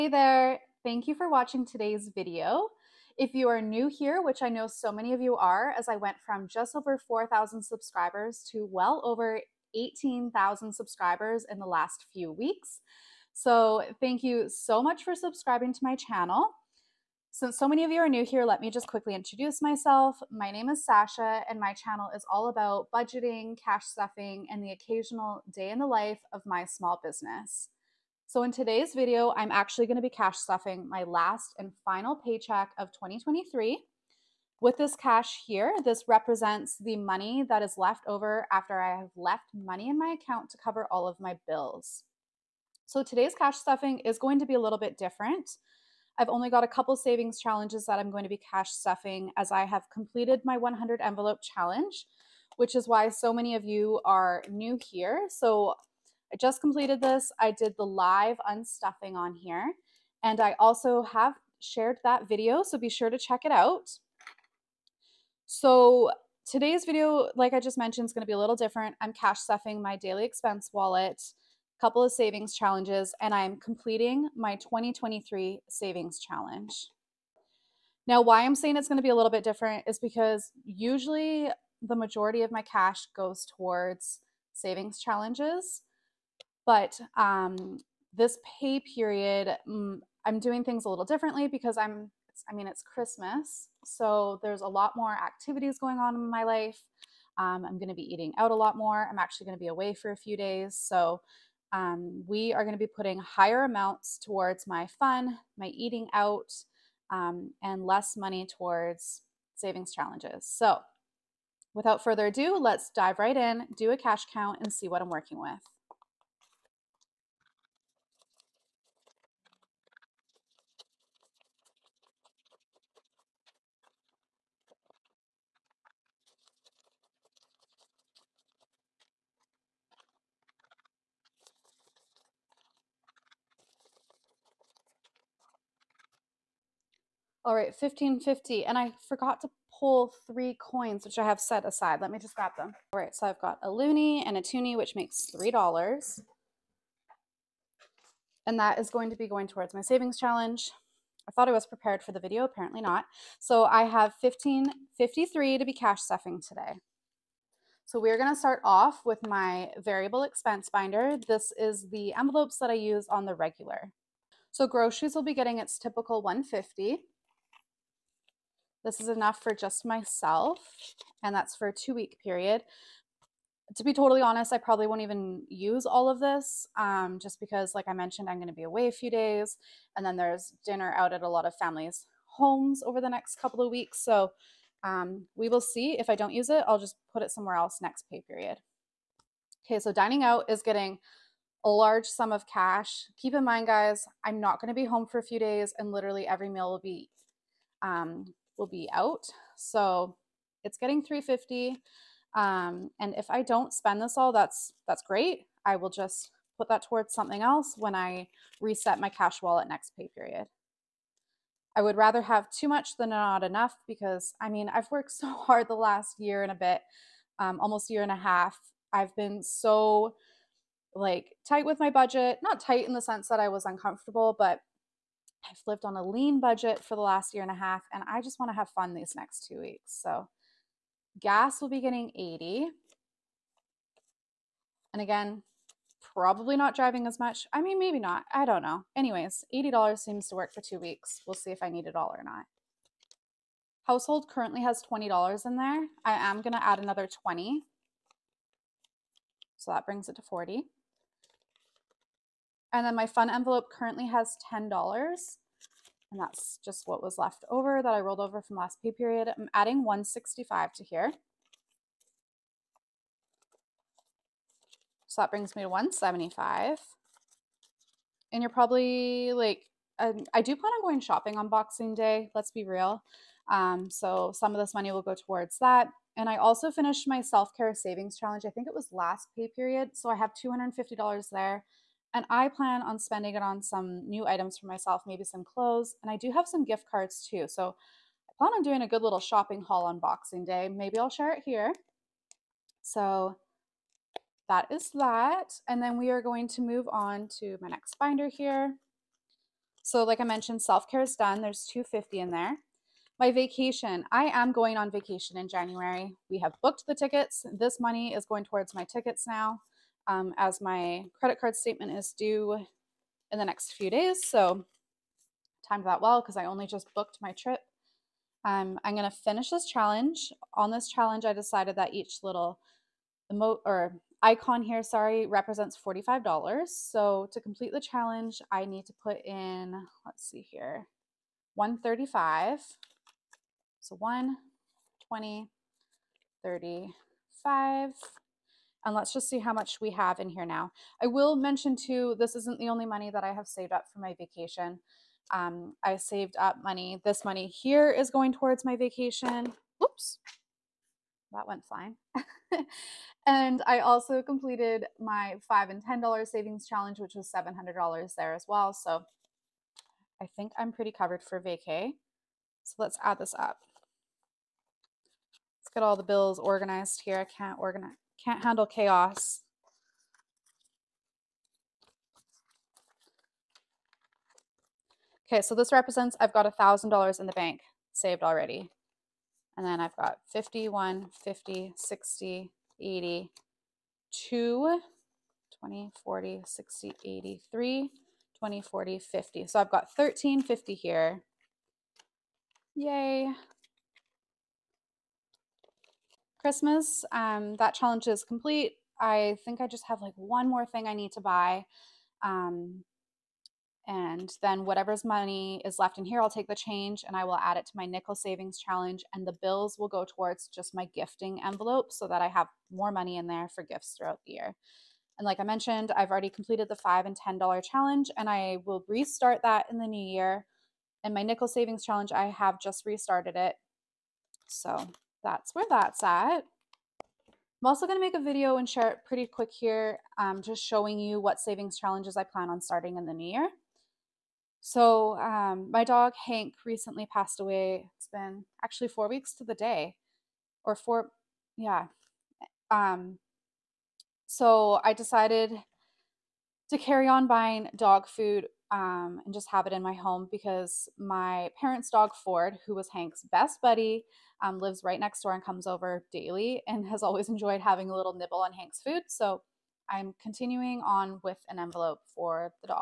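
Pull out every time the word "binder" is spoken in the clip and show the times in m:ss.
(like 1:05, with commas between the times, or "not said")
2:40, 4:57.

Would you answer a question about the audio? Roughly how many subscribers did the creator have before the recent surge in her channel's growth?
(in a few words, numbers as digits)
4,000.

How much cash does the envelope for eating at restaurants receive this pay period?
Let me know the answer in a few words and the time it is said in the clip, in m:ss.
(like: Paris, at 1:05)
$350, at 3:21.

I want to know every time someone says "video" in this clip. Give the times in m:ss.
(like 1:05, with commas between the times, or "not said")
0:02, 0:28, 1:02, 1:06, 2:32, 7:08.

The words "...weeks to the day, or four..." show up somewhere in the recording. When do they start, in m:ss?
7:19.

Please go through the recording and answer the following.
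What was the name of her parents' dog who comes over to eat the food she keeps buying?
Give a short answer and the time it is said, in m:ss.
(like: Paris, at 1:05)
Ford, at 7:32.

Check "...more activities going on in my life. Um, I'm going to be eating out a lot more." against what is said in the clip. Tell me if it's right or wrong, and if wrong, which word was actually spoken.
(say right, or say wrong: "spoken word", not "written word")
right.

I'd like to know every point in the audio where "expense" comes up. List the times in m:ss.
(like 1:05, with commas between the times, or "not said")
1:10, 2:40.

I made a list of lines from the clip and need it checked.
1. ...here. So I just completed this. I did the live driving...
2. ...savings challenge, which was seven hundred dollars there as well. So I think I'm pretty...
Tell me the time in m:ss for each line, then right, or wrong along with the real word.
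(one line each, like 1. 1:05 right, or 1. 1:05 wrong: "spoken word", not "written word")
1. 0:54 wrong: "unstuffing", not "driving"
2. 5:56 right.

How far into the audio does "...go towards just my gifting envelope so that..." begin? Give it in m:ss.
6:49.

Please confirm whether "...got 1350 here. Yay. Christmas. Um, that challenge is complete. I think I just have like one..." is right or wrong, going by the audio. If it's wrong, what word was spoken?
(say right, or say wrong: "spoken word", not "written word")
right.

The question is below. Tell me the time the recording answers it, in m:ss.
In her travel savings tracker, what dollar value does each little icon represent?
5:25.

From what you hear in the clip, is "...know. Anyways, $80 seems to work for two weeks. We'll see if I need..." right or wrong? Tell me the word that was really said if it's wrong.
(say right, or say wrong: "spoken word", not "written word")
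right.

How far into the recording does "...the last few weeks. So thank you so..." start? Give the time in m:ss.
0:11.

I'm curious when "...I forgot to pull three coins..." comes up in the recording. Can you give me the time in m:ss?
2:18.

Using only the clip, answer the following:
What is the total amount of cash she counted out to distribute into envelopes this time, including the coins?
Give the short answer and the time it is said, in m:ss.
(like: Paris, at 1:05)
$1,553, at 2:34.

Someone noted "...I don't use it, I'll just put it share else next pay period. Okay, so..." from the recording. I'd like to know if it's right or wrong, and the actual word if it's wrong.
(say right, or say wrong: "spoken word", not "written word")
wrong: "somewhere", not "share".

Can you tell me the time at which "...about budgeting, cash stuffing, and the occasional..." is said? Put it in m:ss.
0:22.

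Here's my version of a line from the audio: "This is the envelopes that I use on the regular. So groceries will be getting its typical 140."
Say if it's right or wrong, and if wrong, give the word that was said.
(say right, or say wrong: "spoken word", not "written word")
wrong: "150", not "140".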